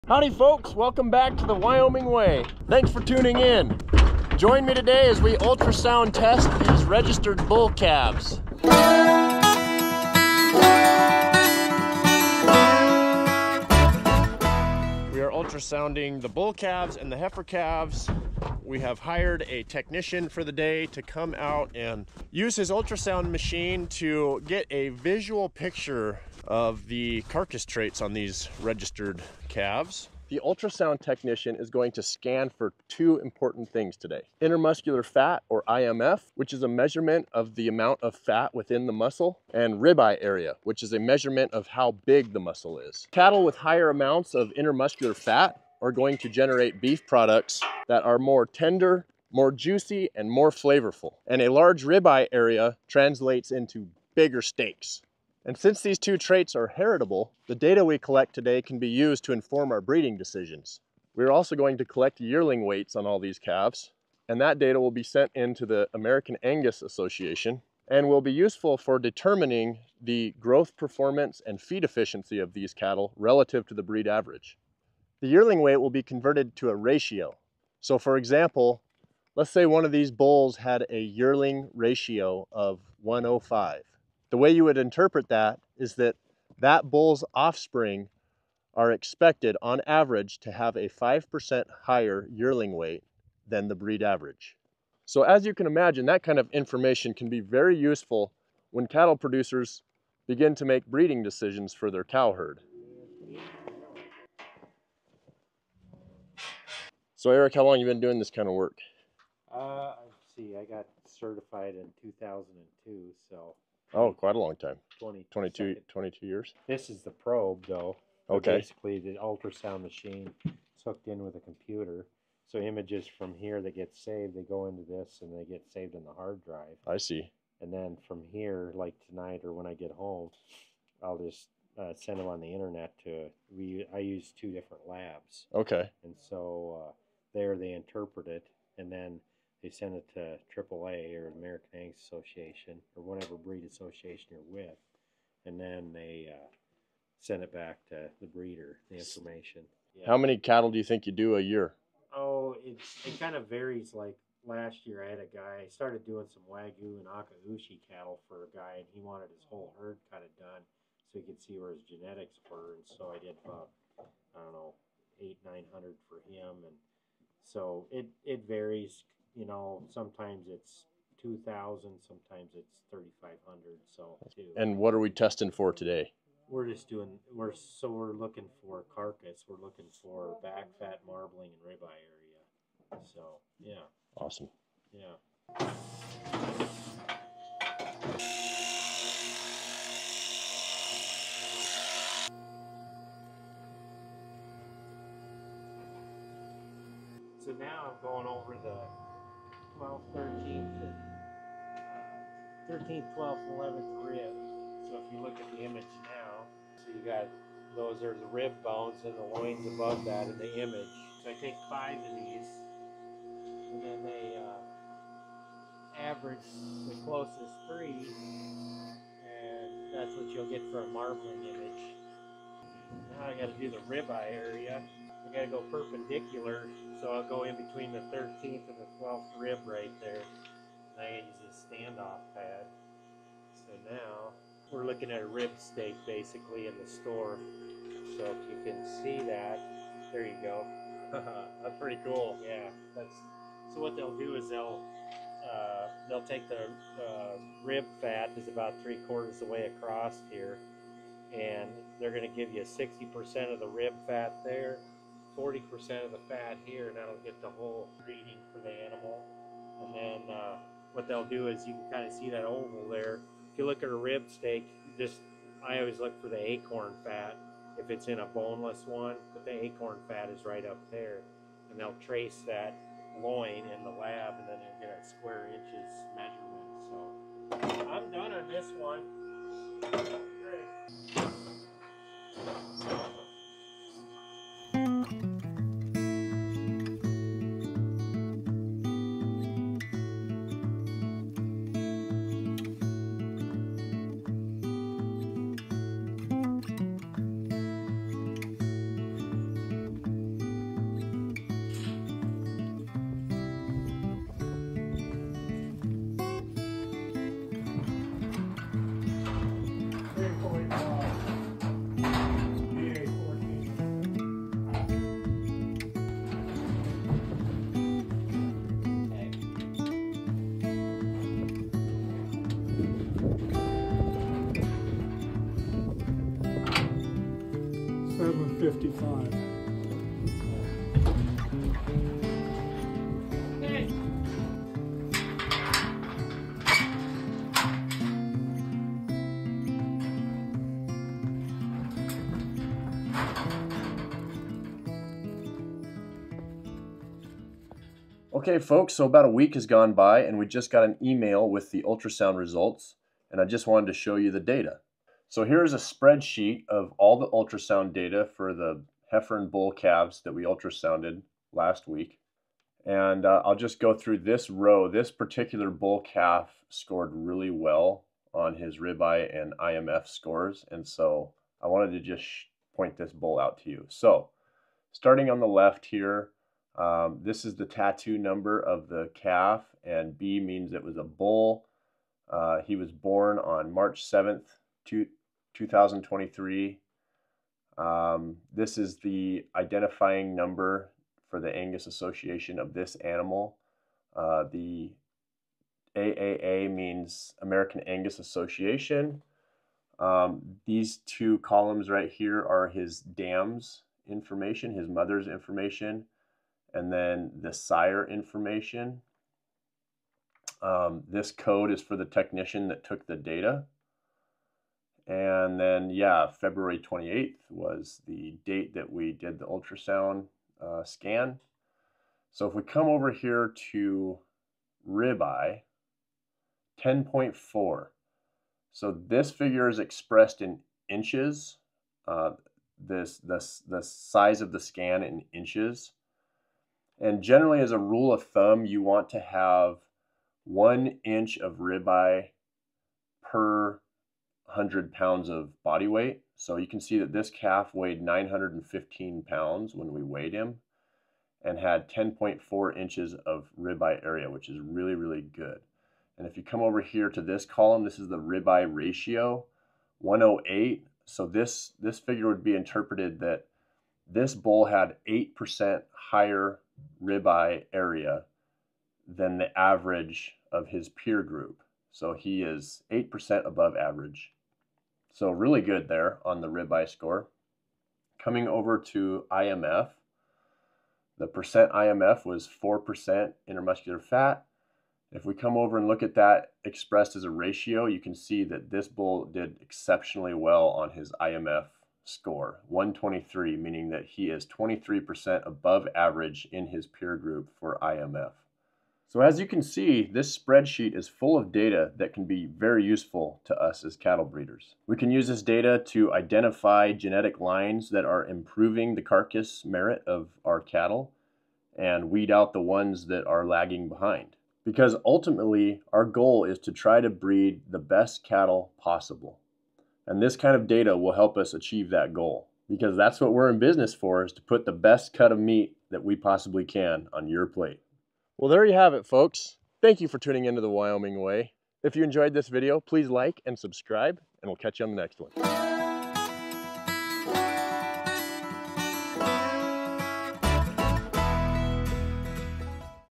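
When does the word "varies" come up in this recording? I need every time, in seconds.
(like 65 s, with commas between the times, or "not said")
153 s, 168 s.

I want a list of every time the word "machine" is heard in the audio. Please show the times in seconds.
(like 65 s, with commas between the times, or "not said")
23 s, 119 s.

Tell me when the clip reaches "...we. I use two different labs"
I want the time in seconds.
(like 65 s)
133 s.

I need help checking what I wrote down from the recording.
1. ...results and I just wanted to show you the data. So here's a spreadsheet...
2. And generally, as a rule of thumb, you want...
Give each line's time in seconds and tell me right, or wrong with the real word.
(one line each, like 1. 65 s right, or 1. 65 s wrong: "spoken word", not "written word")
1. 352 s right
2. 436 s right.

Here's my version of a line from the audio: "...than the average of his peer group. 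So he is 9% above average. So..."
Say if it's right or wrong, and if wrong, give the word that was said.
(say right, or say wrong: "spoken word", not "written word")
wrong: "8", not "9".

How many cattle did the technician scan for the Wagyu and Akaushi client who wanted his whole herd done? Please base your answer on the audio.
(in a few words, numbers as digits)
800-900.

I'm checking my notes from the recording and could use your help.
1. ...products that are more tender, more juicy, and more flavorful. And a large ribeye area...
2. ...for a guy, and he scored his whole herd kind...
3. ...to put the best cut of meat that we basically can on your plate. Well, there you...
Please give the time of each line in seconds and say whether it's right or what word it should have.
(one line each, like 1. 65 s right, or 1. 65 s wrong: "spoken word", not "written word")
1. 47 s right
2. 158 s wrong: "wanted", not "scored"
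3. 524 s wrong: "possibly", not "basically".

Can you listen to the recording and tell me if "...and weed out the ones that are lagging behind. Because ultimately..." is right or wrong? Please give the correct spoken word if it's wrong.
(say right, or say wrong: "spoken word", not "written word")
right.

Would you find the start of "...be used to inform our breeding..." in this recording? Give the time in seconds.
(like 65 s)
58 s.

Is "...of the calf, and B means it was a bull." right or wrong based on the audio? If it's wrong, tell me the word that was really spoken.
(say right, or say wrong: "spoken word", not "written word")
right.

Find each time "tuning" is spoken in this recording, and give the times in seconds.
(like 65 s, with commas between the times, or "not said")
3 s, 530 s.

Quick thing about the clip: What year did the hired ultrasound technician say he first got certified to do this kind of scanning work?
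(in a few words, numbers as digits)
2002.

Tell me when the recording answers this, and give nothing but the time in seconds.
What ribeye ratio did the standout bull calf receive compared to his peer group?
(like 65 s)
459 s.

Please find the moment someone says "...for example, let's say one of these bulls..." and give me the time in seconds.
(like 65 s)
77 s.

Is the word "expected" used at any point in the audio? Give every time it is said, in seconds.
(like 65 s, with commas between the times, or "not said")
88 s.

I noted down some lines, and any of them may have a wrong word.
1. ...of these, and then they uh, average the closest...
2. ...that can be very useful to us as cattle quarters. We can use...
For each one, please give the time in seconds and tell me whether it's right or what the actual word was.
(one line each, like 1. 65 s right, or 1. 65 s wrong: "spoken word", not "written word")
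1. 211 s right
2. 501 s wrong: "breeders", not "quarters".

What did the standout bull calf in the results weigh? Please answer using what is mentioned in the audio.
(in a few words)
915 pounds.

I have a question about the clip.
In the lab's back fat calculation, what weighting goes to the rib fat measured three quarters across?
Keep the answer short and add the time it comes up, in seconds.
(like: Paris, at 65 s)
60%, at 252 s.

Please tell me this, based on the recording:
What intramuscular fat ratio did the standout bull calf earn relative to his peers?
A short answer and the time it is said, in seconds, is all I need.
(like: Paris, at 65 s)
123, at 492 s.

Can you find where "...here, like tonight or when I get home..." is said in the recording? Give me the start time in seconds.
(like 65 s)
128 s.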